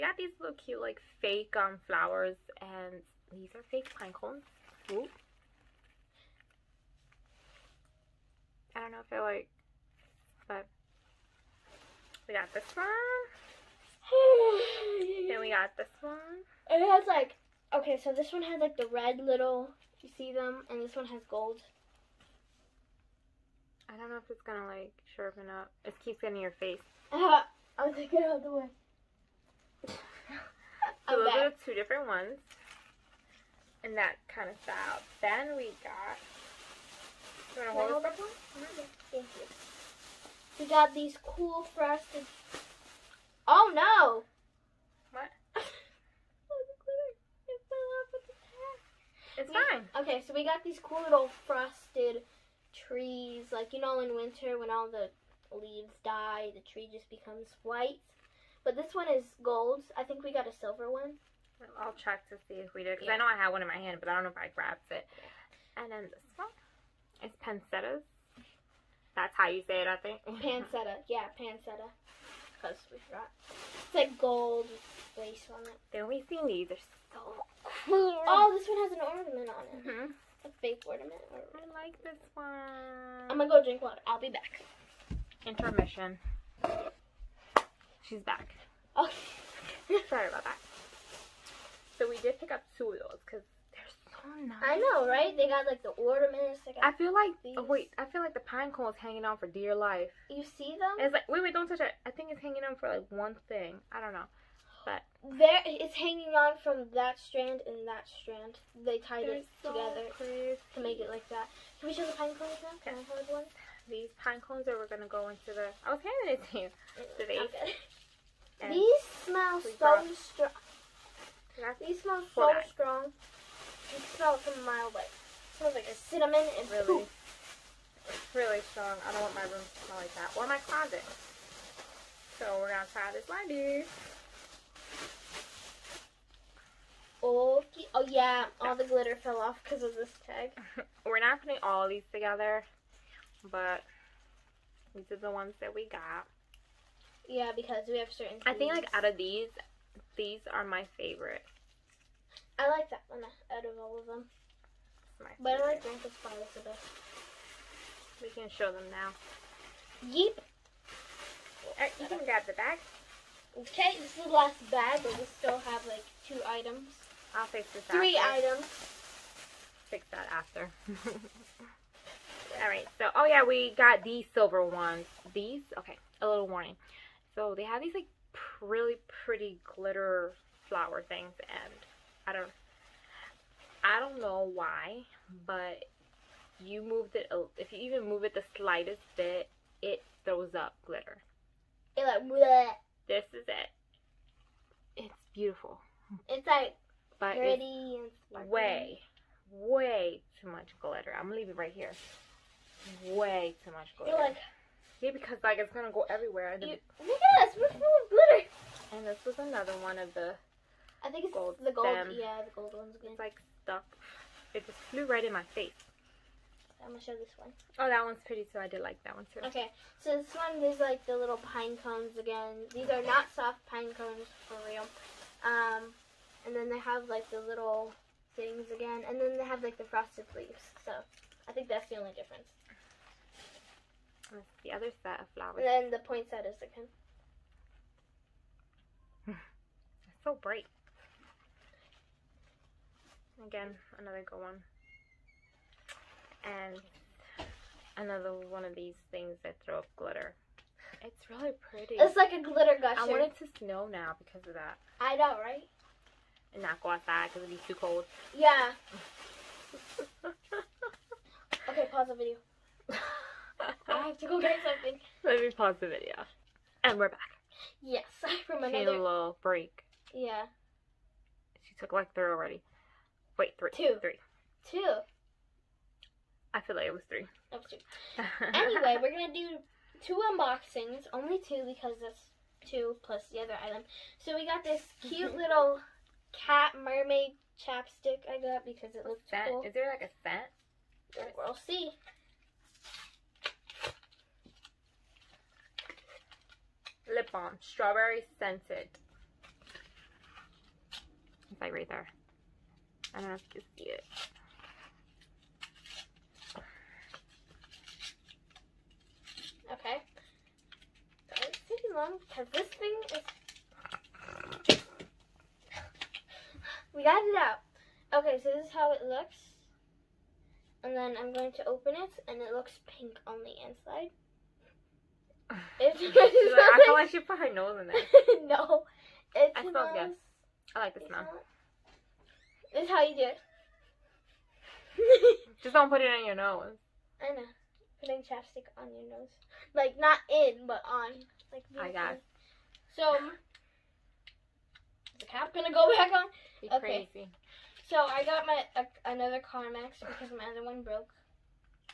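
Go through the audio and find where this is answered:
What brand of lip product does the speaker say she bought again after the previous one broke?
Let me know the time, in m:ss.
5:49.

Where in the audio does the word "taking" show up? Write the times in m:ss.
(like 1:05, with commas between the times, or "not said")
5:11.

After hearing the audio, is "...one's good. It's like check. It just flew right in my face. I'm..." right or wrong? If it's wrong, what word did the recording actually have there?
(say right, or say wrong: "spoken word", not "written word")
wrong: "stuck", not "check".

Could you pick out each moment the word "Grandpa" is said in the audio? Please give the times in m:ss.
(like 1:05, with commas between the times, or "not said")
2:35.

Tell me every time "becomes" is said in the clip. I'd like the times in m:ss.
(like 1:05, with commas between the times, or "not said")
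0:57.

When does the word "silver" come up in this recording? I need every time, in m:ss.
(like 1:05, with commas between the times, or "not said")
1:00, 2:54.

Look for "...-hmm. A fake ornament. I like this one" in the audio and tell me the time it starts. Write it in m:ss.
1:19.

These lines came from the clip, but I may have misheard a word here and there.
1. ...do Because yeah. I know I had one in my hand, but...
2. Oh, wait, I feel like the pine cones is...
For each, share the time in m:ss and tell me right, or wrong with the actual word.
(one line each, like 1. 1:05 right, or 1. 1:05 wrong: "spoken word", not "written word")
1. 1:02 right
2. 1:37 right.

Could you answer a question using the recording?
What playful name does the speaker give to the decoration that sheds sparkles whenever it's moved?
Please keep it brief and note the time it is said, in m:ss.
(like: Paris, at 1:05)
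glitter gusher, at 4:12.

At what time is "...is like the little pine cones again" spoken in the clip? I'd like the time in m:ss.
3:40.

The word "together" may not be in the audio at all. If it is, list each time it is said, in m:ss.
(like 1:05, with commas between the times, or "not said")
1:49, 2:22.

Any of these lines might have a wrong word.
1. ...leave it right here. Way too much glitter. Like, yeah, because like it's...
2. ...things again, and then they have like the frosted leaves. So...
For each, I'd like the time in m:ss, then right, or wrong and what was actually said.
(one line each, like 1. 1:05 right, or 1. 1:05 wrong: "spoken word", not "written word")
1. 3:21 right
2. 3:48 right.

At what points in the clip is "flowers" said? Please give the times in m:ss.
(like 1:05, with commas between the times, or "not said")
0:01, 3:00, 3:55.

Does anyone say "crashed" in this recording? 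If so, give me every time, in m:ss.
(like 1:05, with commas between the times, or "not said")
not said.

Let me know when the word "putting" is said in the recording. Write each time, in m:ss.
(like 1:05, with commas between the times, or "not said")
2:21, 5:38.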